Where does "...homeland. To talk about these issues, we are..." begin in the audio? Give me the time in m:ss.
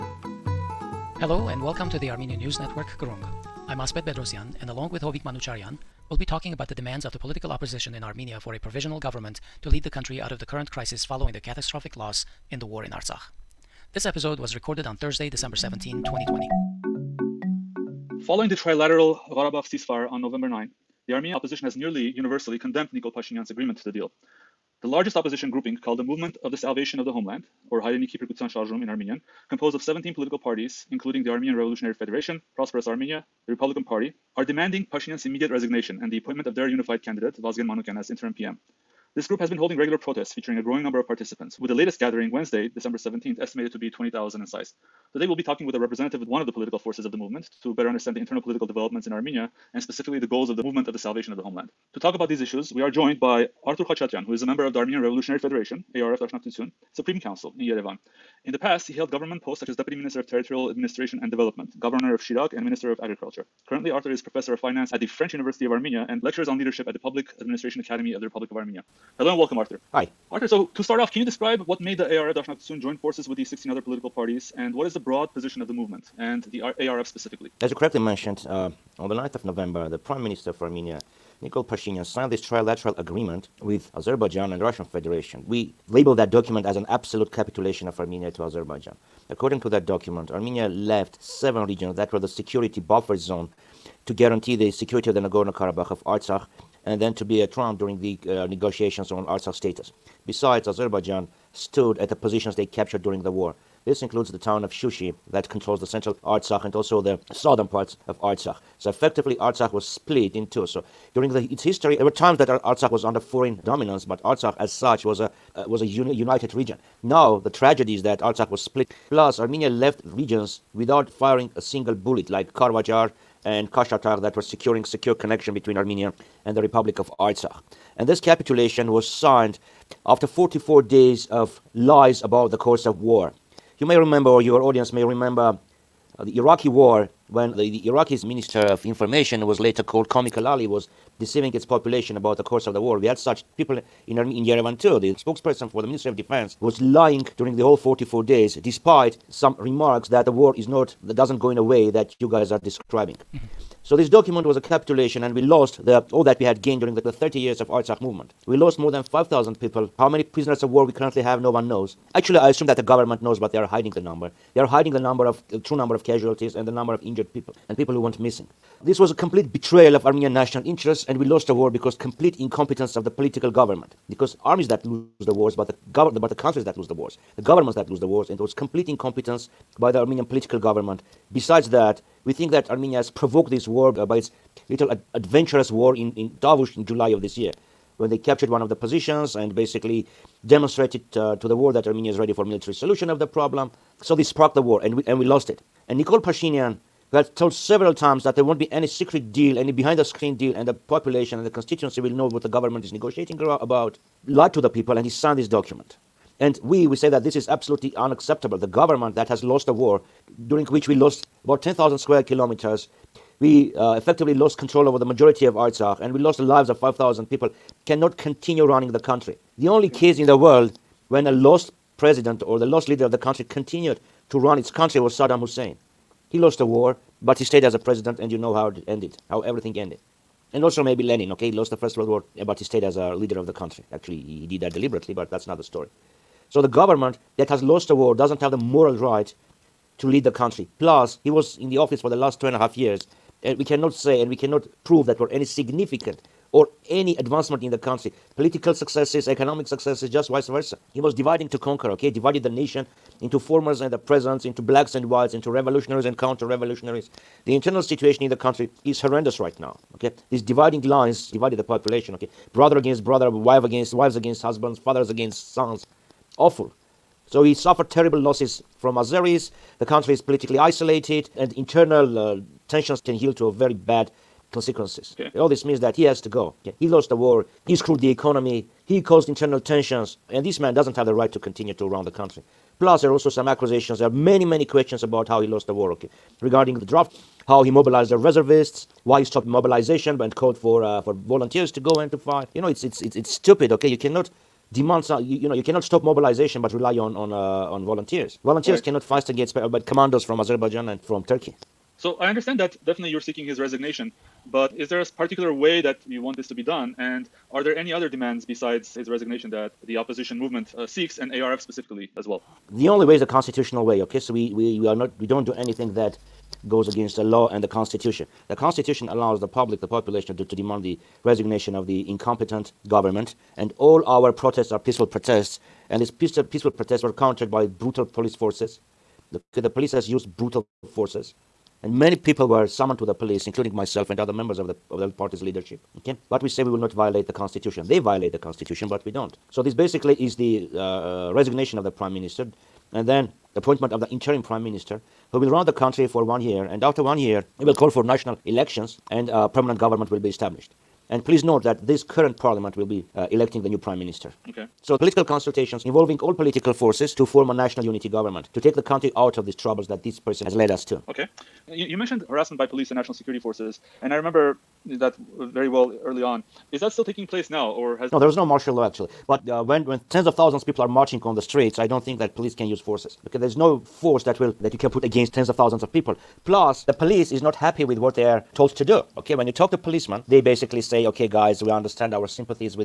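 0:51.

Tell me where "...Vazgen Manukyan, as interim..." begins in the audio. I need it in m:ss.
0:37.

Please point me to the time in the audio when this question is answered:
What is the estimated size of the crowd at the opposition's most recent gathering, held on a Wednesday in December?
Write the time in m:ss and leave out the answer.
0:43.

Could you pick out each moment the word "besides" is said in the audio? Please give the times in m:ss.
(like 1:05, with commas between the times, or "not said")
1:40, 3:01, 5:08.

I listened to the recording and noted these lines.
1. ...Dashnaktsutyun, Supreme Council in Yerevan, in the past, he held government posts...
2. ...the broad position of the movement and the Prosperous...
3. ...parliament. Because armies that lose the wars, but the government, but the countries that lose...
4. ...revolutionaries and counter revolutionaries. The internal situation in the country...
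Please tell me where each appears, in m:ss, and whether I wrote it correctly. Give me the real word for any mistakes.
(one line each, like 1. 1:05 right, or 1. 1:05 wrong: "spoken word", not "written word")
1. 0:56 right
2. 1:14 wrong: "ARF", not "Prosperous"
3. 2:53 wrong: "government", not "parliament"
4. 4:15 right.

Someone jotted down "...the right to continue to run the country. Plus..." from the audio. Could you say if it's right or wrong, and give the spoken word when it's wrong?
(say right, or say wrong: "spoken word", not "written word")
right.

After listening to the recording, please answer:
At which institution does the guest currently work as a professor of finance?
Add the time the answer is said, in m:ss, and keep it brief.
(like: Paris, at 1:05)
French University of Armenia, at 1:05.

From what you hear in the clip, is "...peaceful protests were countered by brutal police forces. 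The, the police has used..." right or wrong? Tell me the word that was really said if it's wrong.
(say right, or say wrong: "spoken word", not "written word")
right.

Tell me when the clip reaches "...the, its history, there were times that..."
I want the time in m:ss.
1:51.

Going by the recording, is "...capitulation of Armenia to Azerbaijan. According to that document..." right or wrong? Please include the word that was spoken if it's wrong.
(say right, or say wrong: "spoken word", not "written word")
right.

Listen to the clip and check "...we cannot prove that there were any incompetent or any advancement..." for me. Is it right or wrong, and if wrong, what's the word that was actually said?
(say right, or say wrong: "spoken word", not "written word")
wrong: "significant", not "incompetent".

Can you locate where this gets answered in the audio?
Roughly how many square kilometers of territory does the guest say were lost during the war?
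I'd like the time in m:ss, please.
3:31.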